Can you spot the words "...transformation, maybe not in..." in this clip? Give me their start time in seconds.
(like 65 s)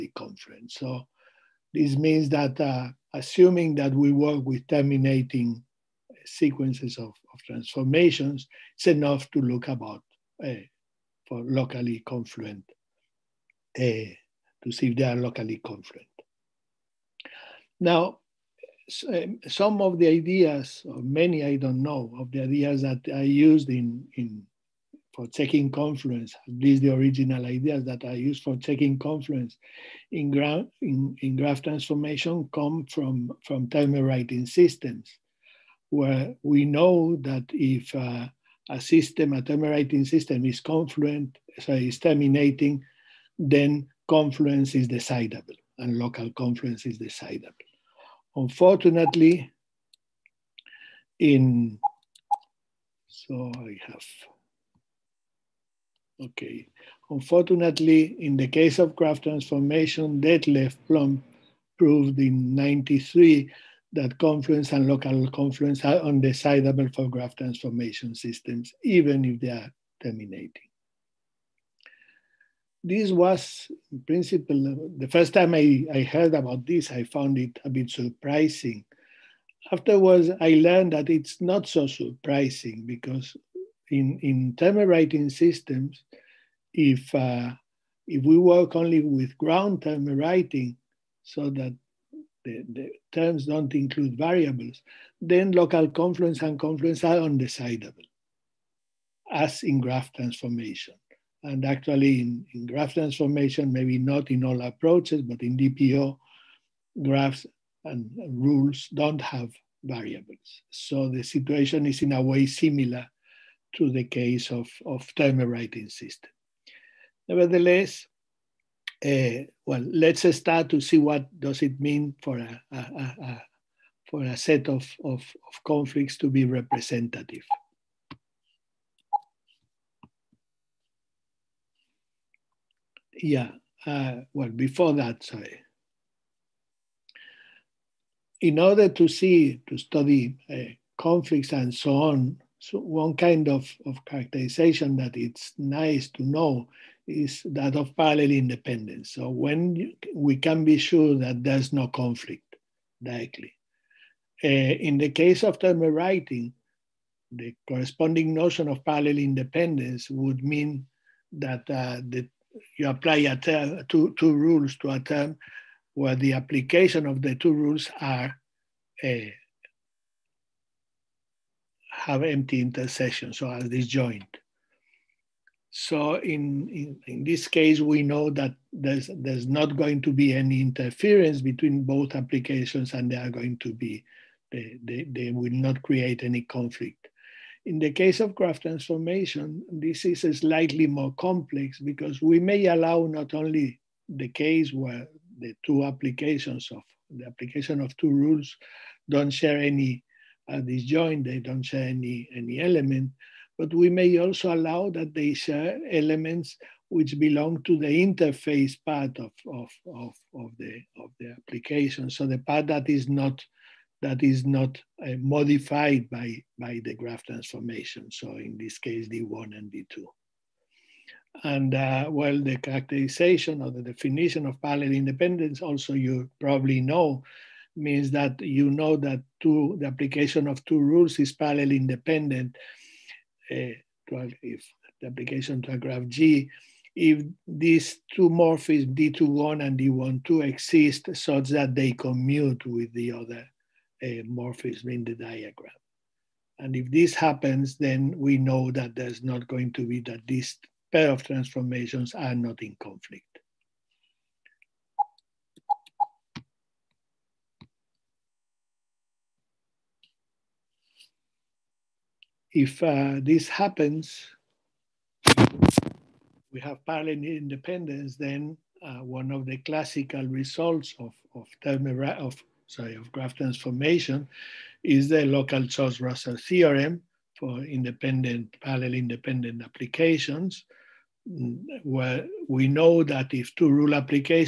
102 s.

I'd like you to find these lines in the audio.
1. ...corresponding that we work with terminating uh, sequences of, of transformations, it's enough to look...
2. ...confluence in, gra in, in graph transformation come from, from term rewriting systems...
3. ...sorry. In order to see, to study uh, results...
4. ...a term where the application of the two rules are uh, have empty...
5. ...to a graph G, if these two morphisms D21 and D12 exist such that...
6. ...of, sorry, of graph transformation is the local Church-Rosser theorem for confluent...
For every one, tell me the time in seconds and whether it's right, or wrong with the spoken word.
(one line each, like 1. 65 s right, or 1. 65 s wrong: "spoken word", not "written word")
1. 3 s wrong: "assuming", not "corresponding"
2. 28 s right
3. 135 s wrong: "conflicts", not "results"
4. 164 s right
5. 235 s right
6. 271 s wrong: "independent", not "confluent".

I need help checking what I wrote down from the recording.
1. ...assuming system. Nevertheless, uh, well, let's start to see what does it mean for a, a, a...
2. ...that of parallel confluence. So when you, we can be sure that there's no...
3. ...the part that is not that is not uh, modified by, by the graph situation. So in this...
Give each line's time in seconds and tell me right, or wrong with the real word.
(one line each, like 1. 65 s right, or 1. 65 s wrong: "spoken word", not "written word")
1. 115 s wrong: "rewriting", not "assuming"
2. 147 s wrong: "independence", not "confluence"
3. 212 s wrong: "transformation", not "situation".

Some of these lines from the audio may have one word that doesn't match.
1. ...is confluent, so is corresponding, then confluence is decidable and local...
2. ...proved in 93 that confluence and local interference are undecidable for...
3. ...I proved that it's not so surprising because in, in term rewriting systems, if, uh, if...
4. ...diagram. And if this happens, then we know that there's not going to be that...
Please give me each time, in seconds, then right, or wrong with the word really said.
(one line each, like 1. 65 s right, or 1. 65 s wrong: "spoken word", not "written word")
1. 40 s wrong: "terminating", not "corresponding"
2. 61 s wrong: "confluence", not "interference"
3. 80 s wrong: "learned", not "proved"
4. 245 s right.